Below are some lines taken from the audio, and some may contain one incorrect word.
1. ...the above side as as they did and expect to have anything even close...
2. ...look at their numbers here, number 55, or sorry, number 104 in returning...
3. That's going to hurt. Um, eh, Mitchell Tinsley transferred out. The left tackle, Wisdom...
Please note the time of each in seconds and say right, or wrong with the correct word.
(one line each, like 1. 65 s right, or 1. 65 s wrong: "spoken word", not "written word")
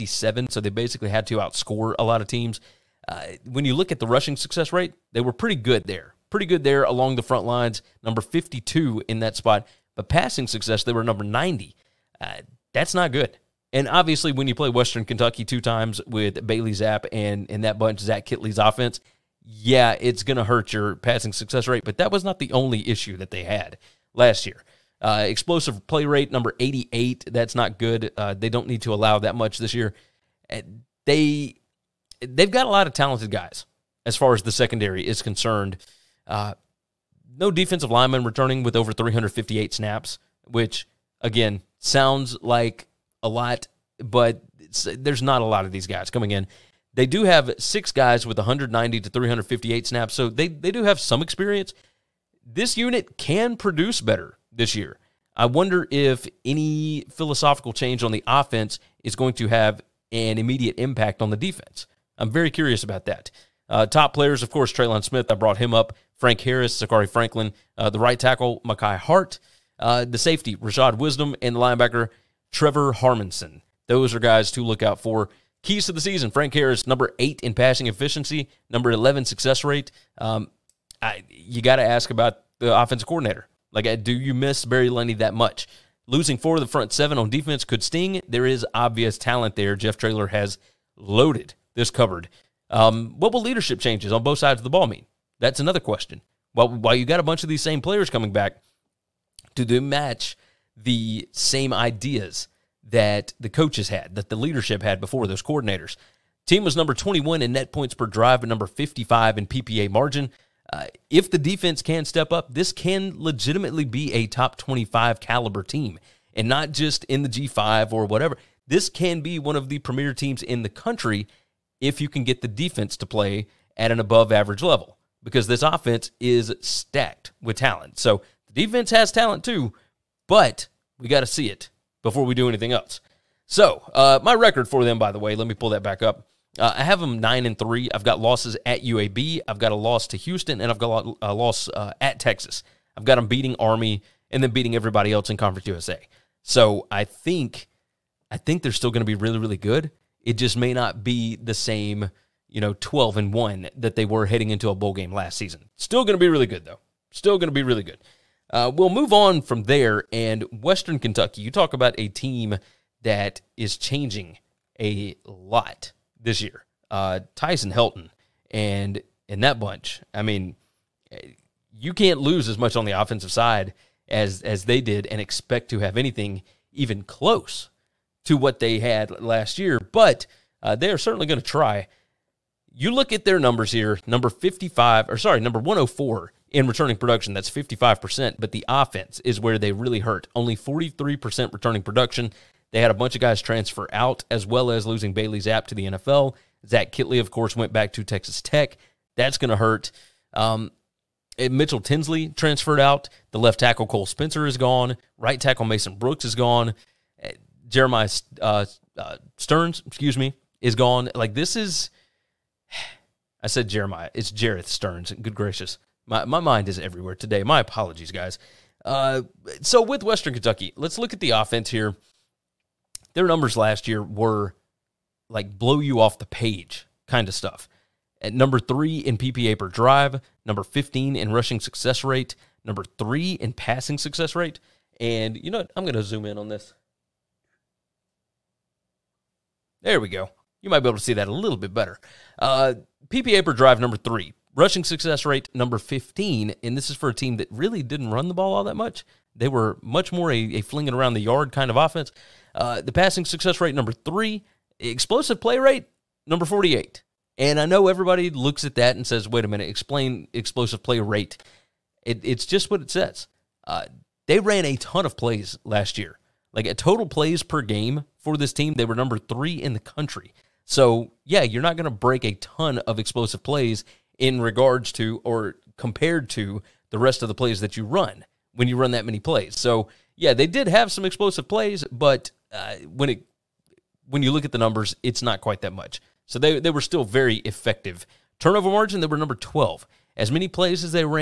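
1. 172 s wrong: "offensive", not "above"
2. 182 s right
3. 199 s wrong: "Cole", not "Wisdom".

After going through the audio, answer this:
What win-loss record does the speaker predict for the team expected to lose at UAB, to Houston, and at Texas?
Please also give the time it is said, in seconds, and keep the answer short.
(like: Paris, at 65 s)
9-3, at 137 s.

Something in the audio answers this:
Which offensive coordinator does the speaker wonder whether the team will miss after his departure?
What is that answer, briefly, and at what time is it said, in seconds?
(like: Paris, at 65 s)
Barry Lunney, at 84 s.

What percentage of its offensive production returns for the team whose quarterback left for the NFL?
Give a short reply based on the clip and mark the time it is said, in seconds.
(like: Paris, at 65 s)
43%, at 190 s.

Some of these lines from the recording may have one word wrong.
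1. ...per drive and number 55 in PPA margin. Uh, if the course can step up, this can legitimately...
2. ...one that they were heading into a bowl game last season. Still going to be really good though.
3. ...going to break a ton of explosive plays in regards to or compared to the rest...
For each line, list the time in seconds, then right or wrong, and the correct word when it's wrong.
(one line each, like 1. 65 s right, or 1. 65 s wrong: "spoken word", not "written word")
1. 107 s wrong: "defense", not "course"
2. 153 s right
3. 271 s right.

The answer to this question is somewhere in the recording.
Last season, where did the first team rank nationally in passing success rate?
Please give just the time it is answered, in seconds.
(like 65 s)
11 s.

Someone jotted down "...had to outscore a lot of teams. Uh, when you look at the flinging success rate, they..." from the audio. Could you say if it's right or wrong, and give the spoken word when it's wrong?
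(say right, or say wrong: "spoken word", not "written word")
wrong: "rushing", not "flinging".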